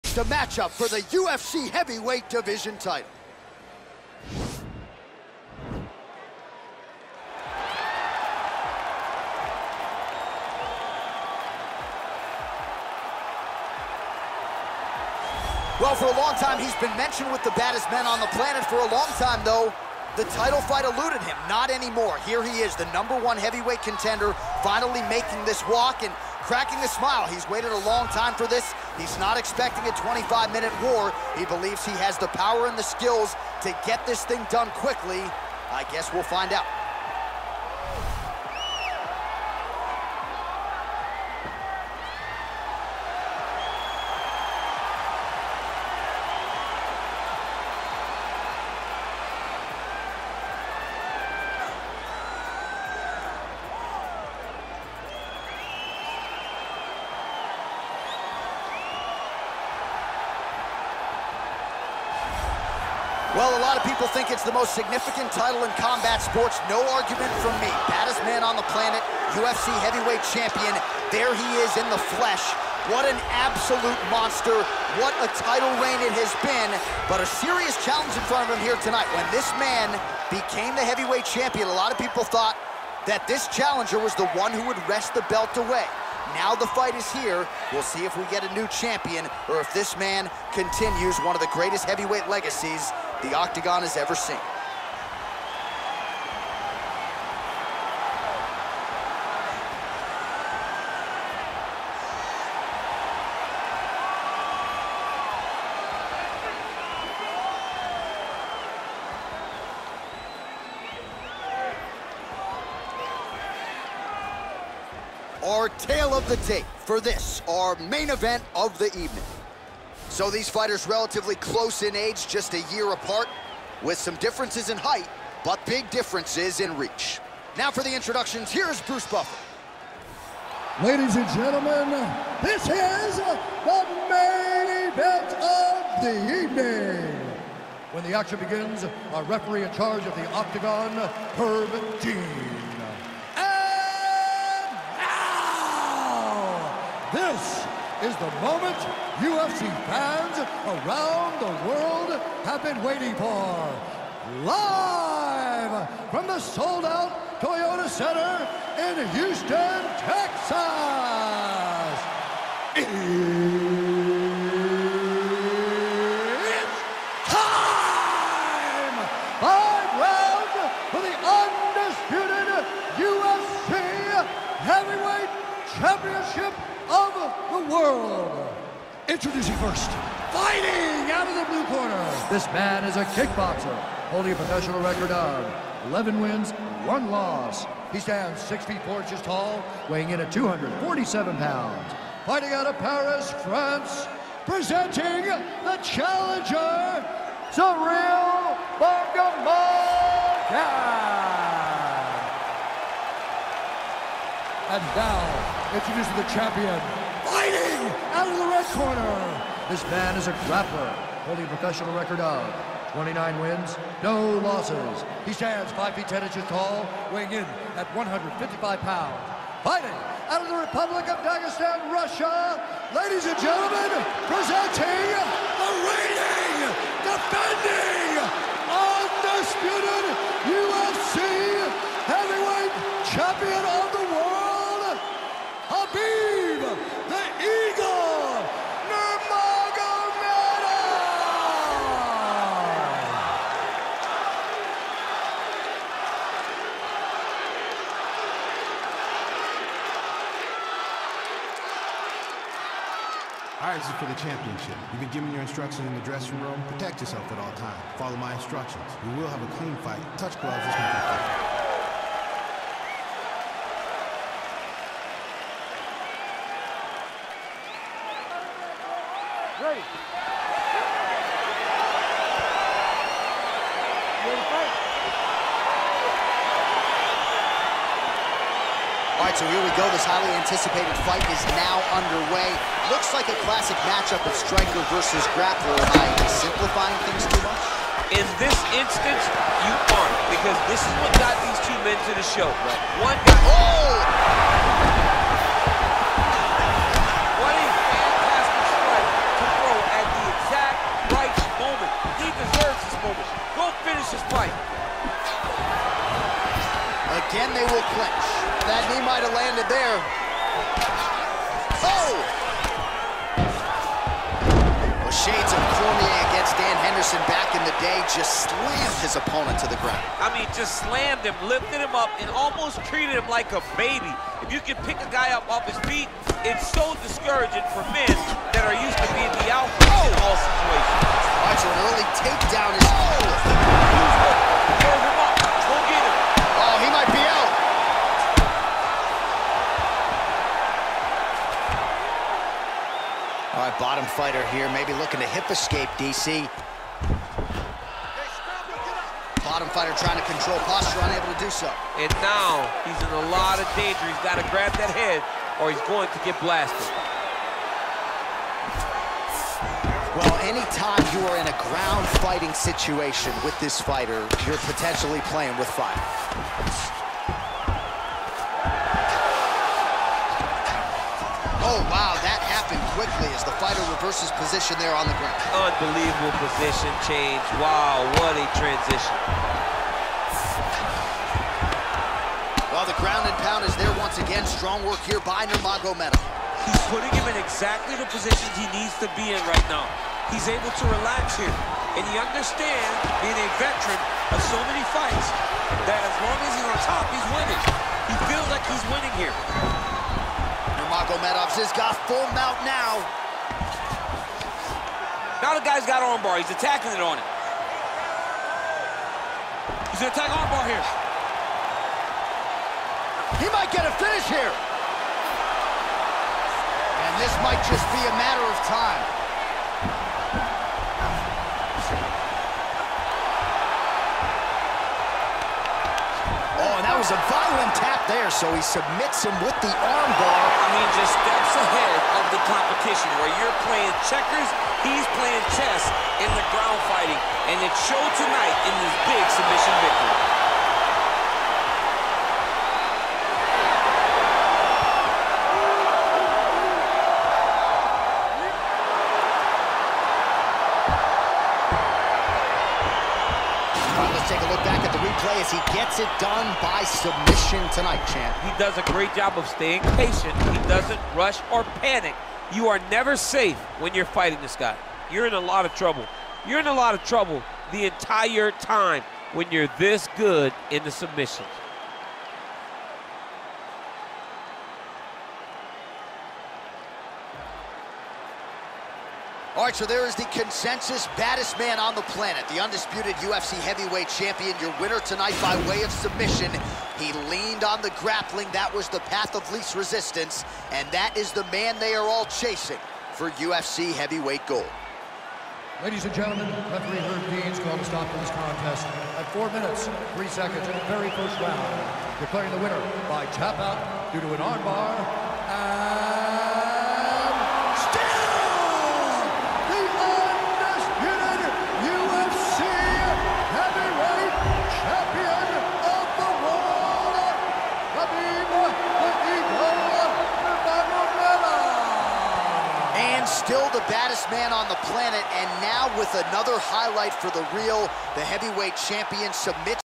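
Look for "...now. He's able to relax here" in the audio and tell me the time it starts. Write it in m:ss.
6:29.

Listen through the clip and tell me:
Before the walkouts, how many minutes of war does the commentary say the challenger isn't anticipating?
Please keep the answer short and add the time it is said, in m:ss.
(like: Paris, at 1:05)
25, at 0:29.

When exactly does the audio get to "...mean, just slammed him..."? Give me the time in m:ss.
5:20.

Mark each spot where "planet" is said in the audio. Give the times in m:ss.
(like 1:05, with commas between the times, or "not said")
0:18, 1:08, 8:02, 8:44.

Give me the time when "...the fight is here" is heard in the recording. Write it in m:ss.
1:26.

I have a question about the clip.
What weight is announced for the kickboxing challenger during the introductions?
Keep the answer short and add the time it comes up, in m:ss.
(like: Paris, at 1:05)
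247 pounds, at 3:10.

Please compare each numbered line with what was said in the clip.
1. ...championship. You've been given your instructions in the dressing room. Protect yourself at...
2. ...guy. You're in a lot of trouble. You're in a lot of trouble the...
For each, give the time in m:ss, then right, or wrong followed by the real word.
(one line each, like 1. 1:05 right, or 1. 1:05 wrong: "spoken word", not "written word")
1. 4:14 right
2. 7:44 right.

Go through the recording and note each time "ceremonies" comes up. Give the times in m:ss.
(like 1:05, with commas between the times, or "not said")
not said.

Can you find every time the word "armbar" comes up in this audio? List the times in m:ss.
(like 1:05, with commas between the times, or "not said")
6:46, 6:50, 7:09, 8:24.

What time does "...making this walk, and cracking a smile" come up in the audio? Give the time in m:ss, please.
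0:25.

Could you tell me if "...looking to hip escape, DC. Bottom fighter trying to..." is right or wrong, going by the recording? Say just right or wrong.
right.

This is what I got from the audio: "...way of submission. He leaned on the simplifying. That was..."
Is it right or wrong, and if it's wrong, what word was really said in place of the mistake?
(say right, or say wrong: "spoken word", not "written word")
wrong: "grappling", not "simplifying".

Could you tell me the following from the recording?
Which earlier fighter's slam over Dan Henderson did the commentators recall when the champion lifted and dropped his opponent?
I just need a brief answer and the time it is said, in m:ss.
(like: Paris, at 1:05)
Cormier, at 5:15.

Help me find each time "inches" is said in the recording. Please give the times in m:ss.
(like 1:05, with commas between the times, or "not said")
3:09, 3:36.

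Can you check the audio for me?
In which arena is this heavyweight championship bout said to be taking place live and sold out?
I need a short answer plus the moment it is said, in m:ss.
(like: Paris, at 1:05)
Toyota Center, at 2:37.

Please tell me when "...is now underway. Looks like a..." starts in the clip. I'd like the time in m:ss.
4:41.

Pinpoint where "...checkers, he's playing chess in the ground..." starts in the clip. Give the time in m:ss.
7:14.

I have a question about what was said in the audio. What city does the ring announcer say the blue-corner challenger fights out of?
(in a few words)
Paris, France.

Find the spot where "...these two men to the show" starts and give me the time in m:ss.
4:51.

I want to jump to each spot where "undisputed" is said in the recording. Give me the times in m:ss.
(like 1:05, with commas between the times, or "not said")
3:48, 8:02.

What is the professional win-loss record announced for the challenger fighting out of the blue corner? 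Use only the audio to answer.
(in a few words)
11 wins, 1 loss.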